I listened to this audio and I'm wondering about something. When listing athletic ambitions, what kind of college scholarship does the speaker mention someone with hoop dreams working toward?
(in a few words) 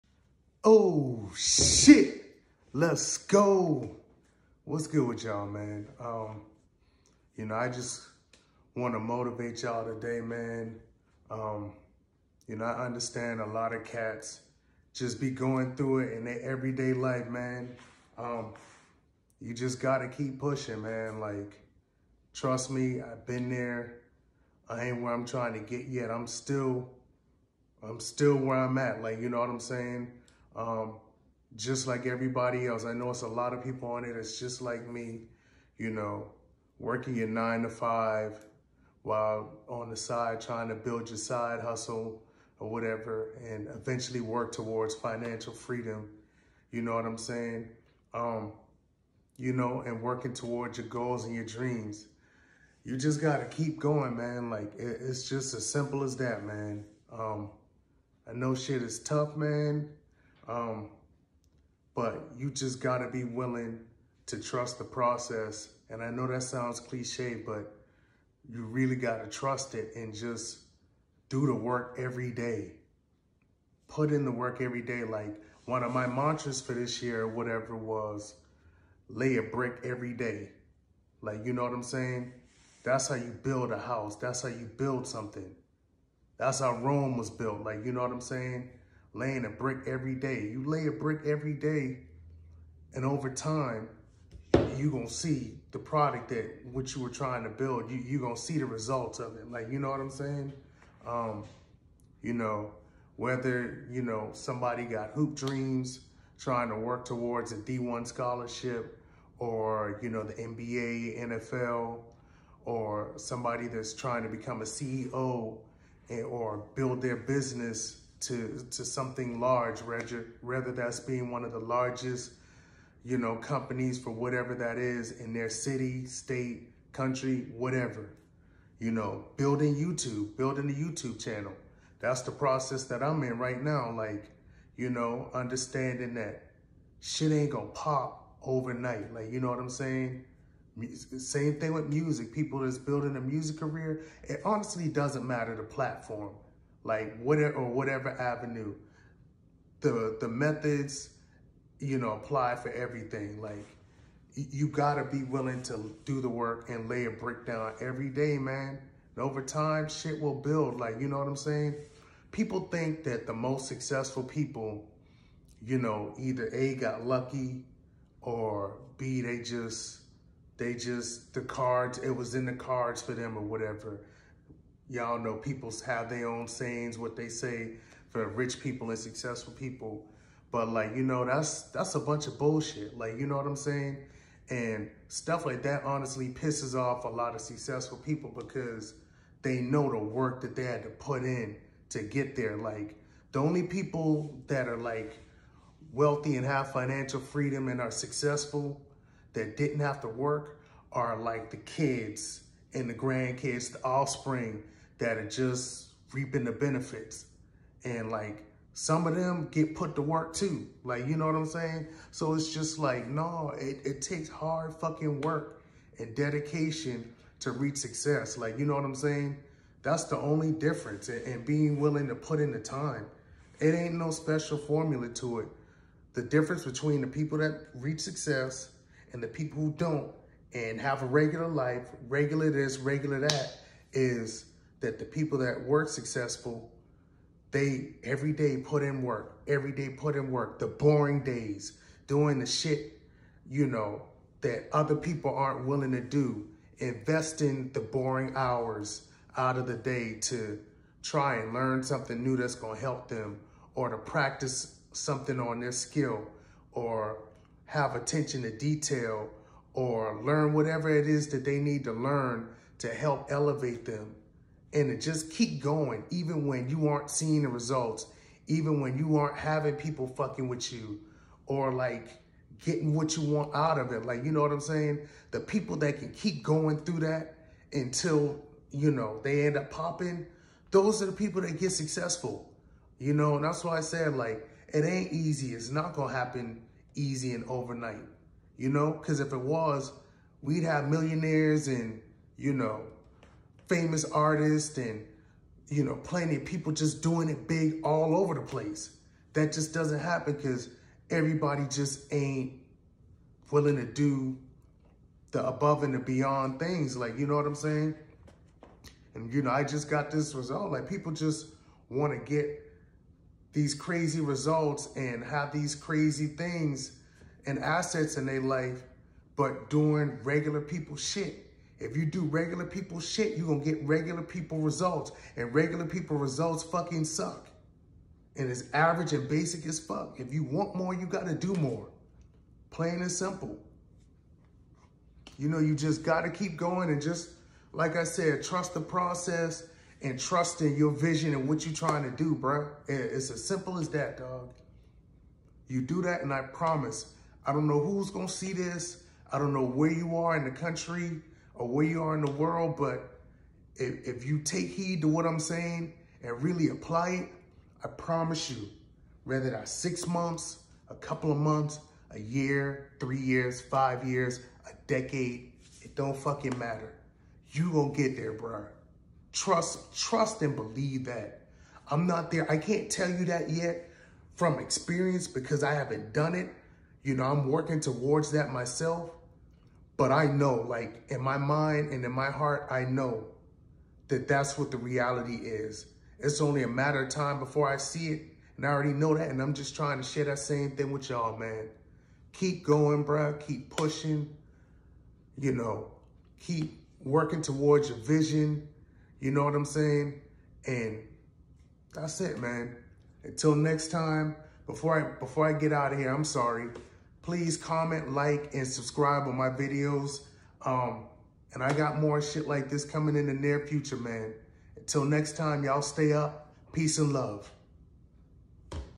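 D1 scholarship.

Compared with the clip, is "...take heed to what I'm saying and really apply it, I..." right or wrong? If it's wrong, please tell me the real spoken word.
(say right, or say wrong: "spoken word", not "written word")
right.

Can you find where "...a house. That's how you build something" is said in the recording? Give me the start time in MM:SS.
01:23.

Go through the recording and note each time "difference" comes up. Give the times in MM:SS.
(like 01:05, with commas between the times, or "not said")
03:40, 03:46.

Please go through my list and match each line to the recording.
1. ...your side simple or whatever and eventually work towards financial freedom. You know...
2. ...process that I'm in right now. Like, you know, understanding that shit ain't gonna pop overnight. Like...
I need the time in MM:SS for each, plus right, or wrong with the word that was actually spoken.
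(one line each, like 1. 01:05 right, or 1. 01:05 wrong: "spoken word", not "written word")
1. 00:41 wrong: "hustle", not "simple"
2. 02:12 right.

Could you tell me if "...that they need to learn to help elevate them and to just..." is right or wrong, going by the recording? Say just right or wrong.
right.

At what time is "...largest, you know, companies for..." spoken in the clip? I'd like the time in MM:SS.
02:01.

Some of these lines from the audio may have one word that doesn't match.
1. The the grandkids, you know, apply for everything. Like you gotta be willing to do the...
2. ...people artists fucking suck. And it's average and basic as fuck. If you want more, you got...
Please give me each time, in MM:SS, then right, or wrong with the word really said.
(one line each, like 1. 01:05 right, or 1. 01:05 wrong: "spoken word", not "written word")
1. 02:29 wrong: "methods", not "grandkids"
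2. 05:25 wrong: "results", not "artists".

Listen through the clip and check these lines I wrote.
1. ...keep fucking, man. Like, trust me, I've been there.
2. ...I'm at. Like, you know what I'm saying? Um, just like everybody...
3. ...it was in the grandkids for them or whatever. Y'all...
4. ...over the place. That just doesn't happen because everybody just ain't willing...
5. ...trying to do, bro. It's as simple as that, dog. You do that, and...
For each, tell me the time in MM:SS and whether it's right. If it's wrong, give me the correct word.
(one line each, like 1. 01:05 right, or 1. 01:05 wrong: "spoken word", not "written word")
1. 00:20 wrong: "pushing", not "fucking"
2. 00:28 right
3. 02:51 wrong: "cards", not "grandkids"
4. 04:58 right
5. 05:41 right.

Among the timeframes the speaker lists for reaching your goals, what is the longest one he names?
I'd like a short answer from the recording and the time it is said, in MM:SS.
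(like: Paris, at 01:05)
A decade, at 06:04.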